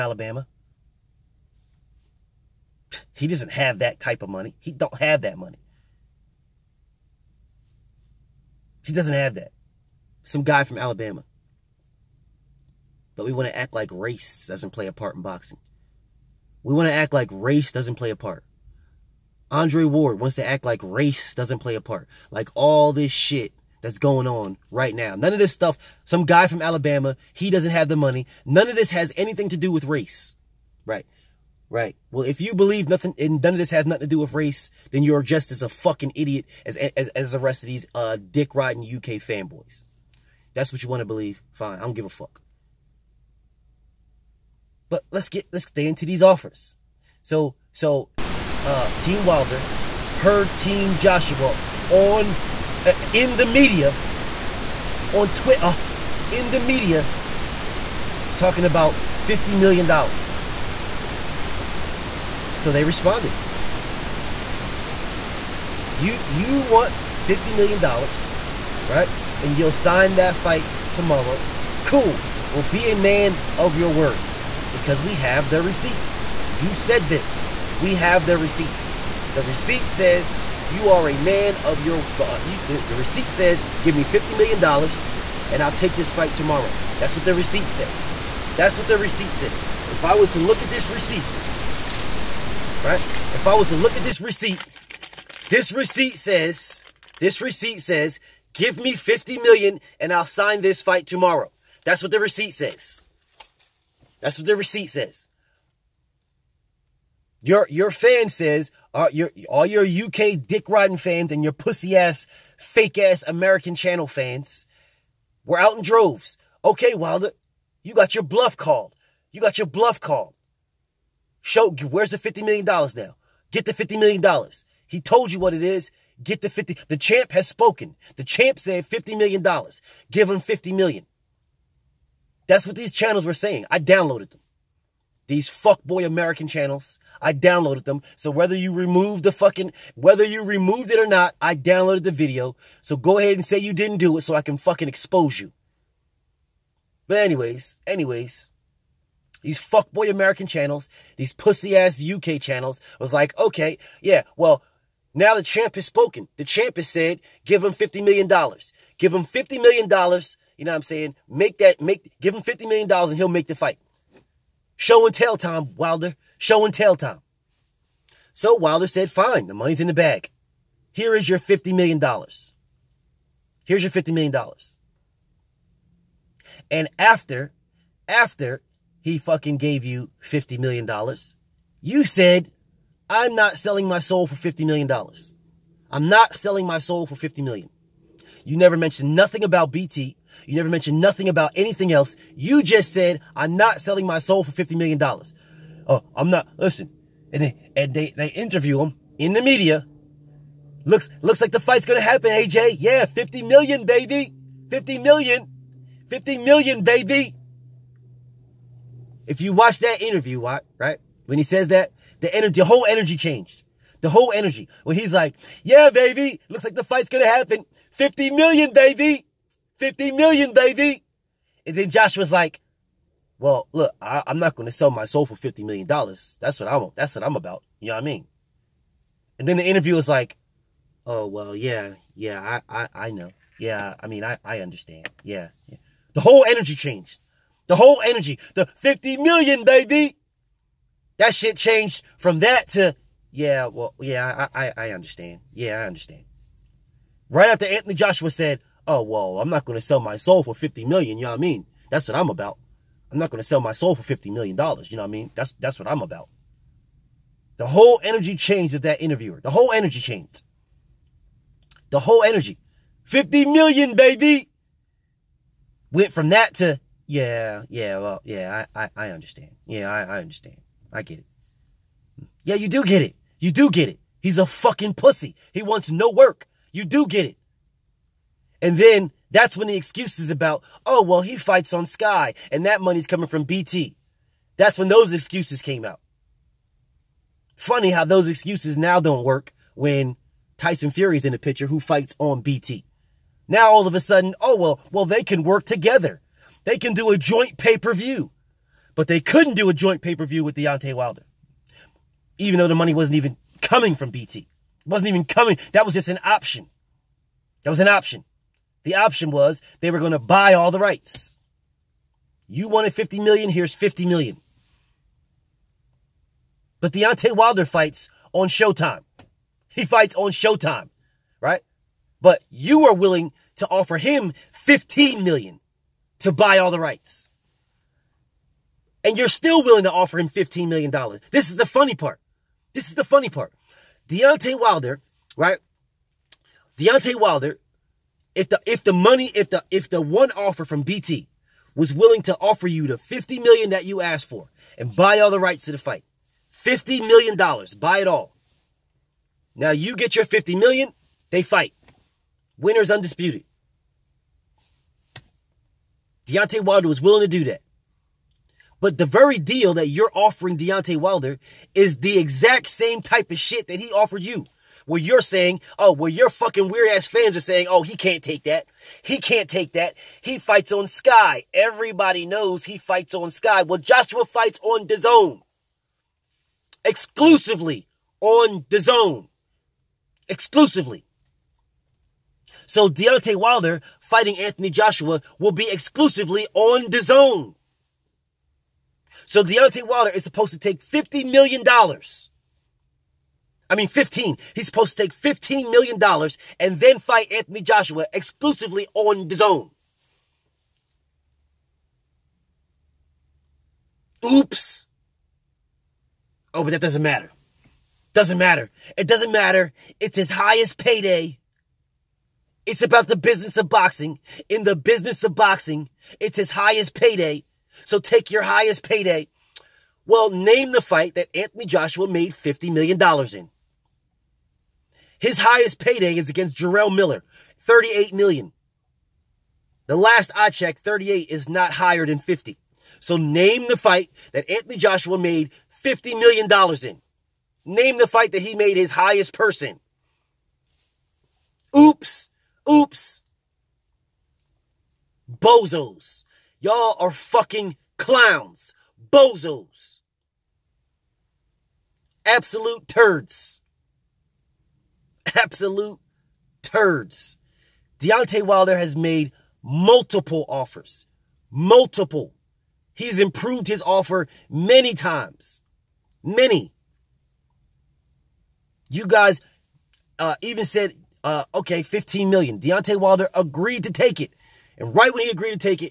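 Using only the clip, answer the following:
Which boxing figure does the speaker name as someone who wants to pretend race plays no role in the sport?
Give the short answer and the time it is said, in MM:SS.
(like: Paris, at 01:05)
Andre Ward, at 00:19.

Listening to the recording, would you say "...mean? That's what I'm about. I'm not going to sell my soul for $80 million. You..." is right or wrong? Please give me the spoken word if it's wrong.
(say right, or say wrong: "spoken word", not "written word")
wrong: "50", not "80".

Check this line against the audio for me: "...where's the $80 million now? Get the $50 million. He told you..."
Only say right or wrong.
wrong.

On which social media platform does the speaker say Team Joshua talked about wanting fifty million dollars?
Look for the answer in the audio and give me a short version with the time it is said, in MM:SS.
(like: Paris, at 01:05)
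Twitter, at 00:55.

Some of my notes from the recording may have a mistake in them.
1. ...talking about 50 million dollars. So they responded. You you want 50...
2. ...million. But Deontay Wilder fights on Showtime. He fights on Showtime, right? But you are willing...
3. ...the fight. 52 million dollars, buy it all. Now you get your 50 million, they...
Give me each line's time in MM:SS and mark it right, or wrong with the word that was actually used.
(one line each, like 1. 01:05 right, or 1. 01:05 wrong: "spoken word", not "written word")
1. 00:58 right
2. 05:14 right
3. 05:45 wrong: "50", not "52".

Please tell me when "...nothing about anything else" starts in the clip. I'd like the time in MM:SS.
03:10.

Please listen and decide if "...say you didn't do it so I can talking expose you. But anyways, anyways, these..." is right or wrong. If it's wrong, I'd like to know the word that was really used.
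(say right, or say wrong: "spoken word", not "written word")
wrong: "fucking", not "talking".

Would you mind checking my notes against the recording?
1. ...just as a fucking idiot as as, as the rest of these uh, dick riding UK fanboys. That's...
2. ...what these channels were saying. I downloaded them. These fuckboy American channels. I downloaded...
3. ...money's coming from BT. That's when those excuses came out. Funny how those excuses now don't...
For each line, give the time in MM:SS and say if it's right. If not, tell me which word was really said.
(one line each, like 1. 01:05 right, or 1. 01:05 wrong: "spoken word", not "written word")
1. 00:35 right
2. 02:12 right
3. 04:42 right.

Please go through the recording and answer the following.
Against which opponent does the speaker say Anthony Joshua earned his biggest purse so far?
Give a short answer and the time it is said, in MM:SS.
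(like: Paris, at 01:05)
Jarrell Miller, at 07:06.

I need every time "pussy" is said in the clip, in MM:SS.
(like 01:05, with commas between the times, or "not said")
01:51, 02:31, 04:34.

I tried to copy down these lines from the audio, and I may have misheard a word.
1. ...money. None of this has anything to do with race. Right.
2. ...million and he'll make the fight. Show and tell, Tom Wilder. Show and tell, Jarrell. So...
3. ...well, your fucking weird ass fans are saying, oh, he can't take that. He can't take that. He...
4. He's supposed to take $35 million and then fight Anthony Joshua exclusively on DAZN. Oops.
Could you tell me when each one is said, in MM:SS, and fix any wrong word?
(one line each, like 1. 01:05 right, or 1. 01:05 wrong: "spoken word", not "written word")
1. 00:27 right
2. 02:42 wrong: "Tom", not "Jarrell"
3. 06:05 right
4. 06:34 wrong: "15", not "35".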